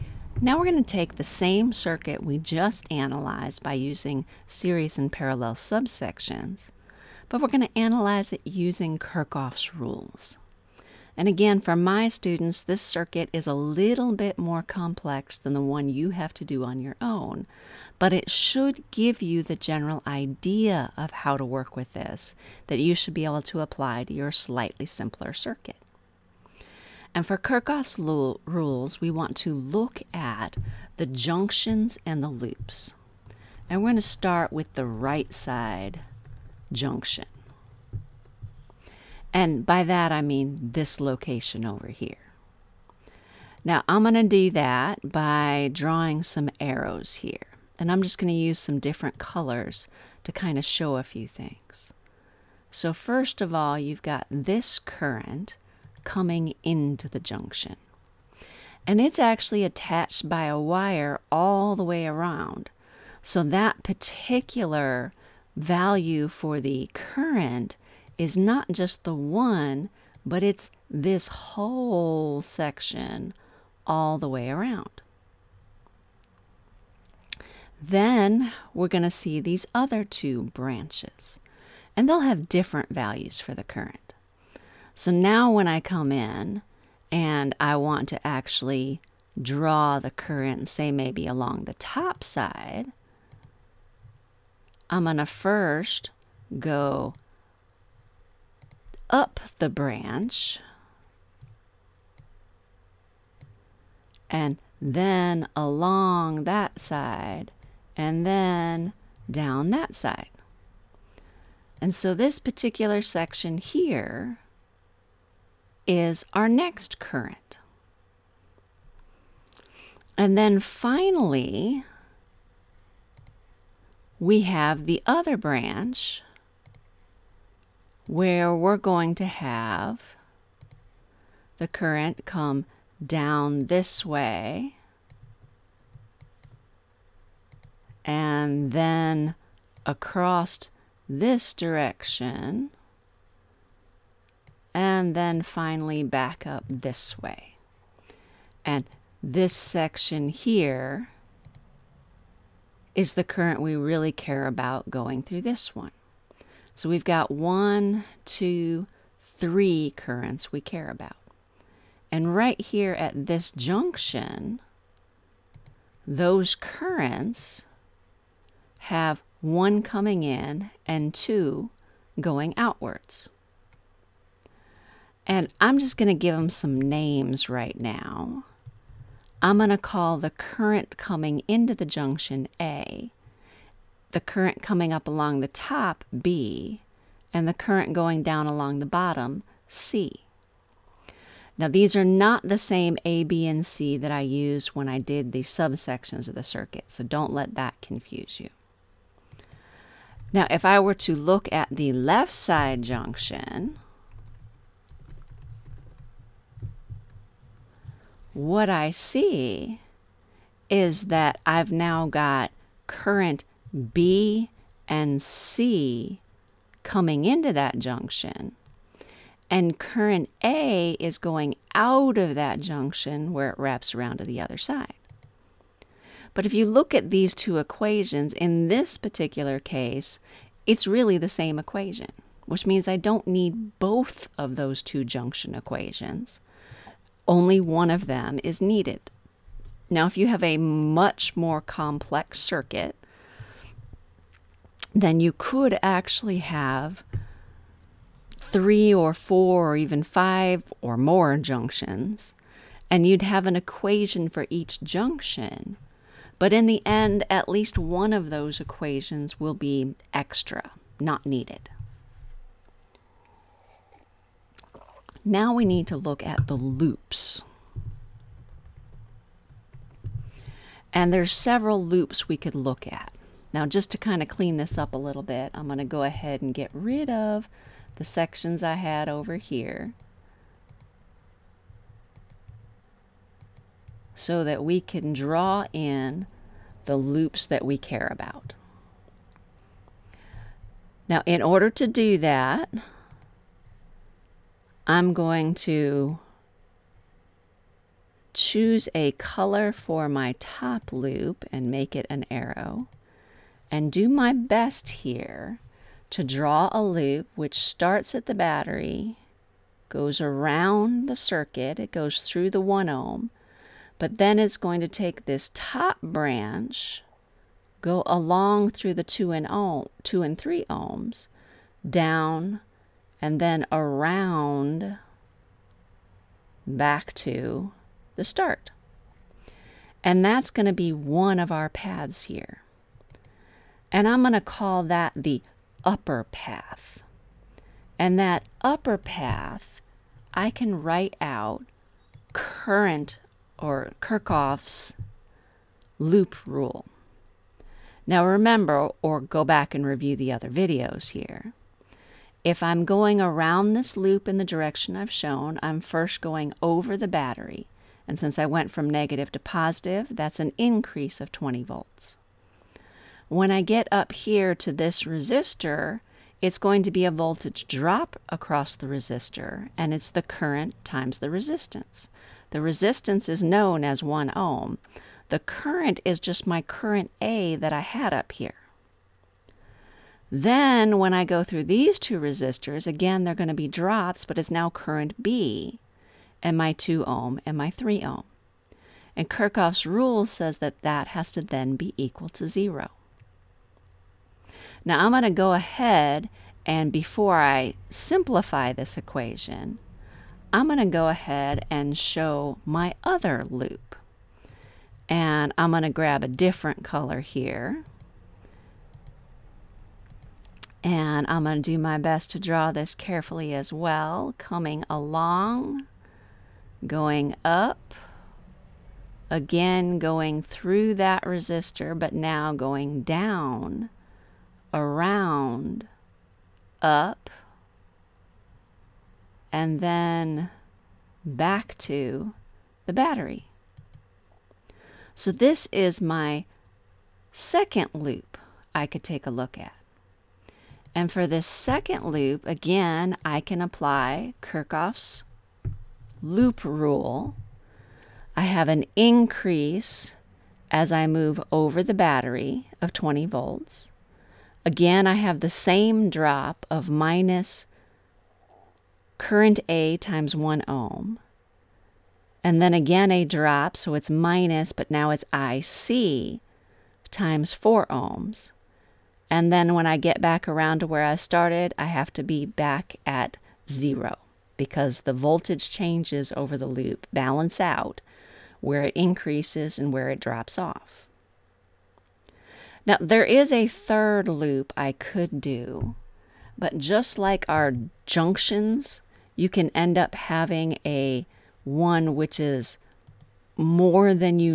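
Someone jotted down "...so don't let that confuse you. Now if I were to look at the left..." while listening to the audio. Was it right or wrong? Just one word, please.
right.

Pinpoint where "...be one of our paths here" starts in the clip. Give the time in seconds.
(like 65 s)
330 s.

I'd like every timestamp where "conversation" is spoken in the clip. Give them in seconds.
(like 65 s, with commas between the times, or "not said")
not said.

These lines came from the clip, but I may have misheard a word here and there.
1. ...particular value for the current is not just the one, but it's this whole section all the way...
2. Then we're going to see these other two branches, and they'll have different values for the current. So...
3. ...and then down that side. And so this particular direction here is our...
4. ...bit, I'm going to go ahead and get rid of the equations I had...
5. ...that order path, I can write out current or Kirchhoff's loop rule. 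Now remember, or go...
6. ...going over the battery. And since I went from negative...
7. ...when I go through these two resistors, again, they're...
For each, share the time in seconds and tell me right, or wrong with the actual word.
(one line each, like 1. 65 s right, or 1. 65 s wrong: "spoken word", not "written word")
1. 63 s right
2. 77 s right
3. 107 s wrong: "section", not "direction"
4. 275 s wrong: "sections", not "equations"
5. 338 s wrong: "upper", not "order"
6. 356 s right
7. 380 s right.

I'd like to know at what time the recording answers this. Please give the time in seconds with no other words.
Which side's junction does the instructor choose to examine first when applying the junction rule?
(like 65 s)
34 s.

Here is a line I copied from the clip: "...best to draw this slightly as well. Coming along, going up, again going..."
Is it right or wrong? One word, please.
wrong.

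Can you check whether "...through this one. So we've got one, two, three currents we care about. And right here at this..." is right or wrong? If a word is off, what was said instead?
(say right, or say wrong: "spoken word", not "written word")
right.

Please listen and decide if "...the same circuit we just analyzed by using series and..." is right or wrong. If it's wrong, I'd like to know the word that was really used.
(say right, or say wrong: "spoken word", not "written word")
right.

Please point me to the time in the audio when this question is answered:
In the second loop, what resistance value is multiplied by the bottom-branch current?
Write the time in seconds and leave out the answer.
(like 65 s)
467 s.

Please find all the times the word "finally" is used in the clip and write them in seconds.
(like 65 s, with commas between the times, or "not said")
120 s, 145 s.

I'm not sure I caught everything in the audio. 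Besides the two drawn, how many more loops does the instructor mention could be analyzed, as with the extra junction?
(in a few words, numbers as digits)
A third loop.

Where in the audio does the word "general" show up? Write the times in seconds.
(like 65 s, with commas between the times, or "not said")
19 s.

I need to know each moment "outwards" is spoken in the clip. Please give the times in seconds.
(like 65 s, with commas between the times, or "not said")
172 s.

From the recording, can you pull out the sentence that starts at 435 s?
So this is my second loop I could take a look at.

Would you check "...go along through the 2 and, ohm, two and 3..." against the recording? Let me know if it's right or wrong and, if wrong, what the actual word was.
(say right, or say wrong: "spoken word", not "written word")
right.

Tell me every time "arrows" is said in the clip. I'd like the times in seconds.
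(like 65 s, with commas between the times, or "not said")
46 s, 302 s.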